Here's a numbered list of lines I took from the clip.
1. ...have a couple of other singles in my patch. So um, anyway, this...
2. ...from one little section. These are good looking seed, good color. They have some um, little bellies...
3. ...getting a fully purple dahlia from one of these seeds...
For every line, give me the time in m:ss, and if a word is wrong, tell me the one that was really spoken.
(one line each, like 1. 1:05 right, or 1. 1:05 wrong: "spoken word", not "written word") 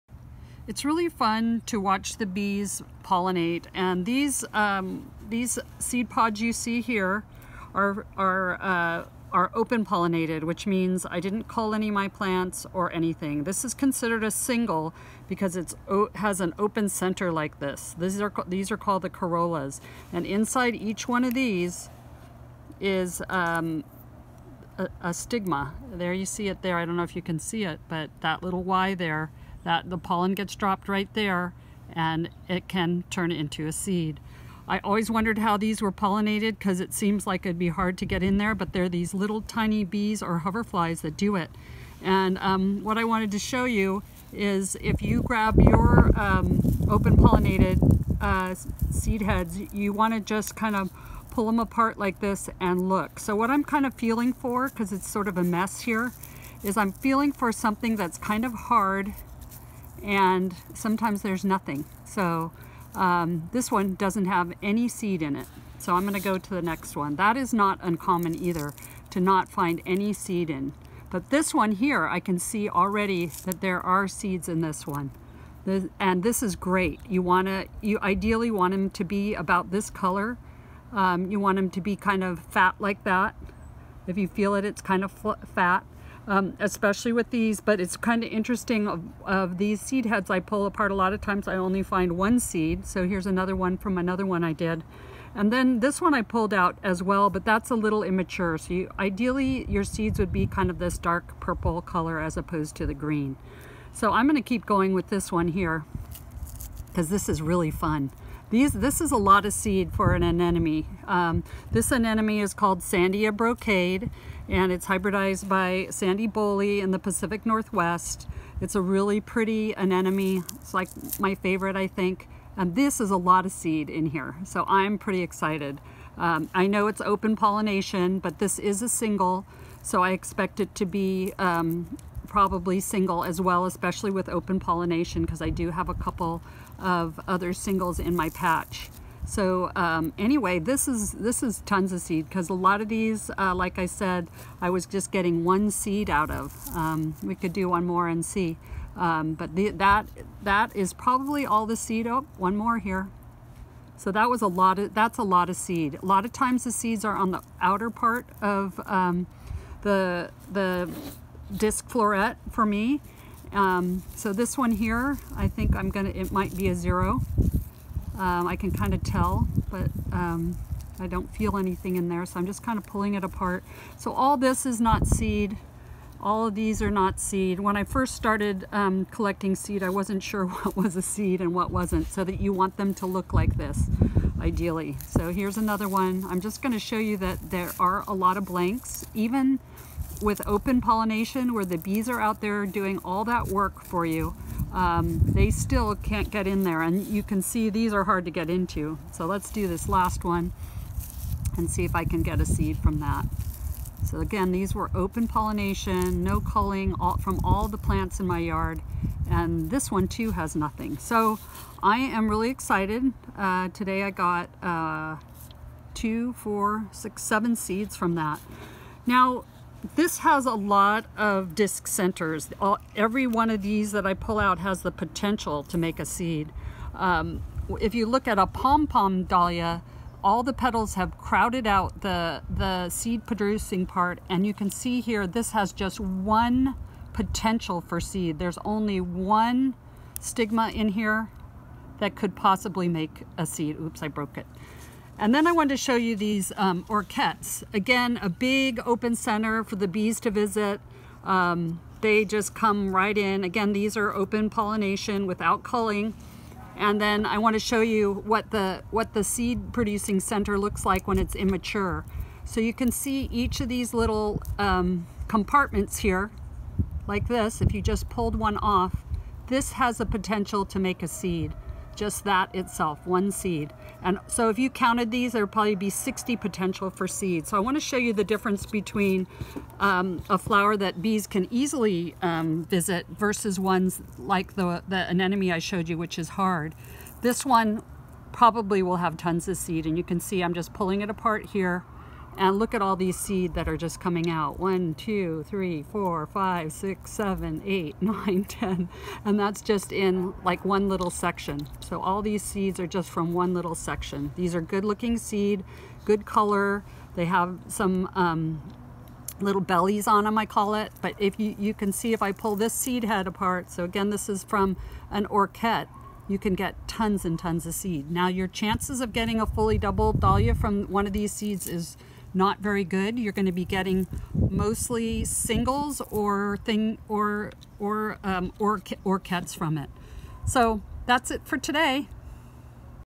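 1. 2:15 right
2. 5:03 right
3. 5:19 wrong: "double", not "purple".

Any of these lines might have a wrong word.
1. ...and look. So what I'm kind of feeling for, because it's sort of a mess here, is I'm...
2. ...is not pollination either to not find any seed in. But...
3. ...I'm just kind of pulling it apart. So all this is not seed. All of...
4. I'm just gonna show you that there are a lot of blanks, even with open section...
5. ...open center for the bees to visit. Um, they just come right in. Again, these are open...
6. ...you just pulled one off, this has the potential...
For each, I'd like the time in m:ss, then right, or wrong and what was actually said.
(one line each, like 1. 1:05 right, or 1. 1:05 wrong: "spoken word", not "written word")
1. 0:52 right
2. 1:07 wrong: "uncommon", not "pollination"
3. 2:52 right
4. 3:06 wrong: "pollination", not "section"
5. 4:08 right
6. 4:27 right.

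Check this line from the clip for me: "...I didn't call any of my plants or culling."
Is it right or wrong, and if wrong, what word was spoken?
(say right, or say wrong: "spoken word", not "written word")
wrong: "anything", not "culling".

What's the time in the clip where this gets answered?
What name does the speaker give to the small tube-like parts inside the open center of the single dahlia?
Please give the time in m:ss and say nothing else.
0:19.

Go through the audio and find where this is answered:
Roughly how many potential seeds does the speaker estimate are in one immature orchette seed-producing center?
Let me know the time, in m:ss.
4:35.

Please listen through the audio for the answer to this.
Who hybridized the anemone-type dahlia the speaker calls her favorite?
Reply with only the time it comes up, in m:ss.
1:55.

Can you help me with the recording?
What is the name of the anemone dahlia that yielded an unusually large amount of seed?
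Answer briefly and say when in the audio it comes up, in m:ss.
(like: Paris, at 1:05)
Sandia brocade, at 1:52.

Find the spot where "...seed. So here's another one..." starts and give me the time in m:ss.
1:32.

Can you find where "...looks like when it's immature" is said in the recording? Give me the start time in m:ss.
4:20.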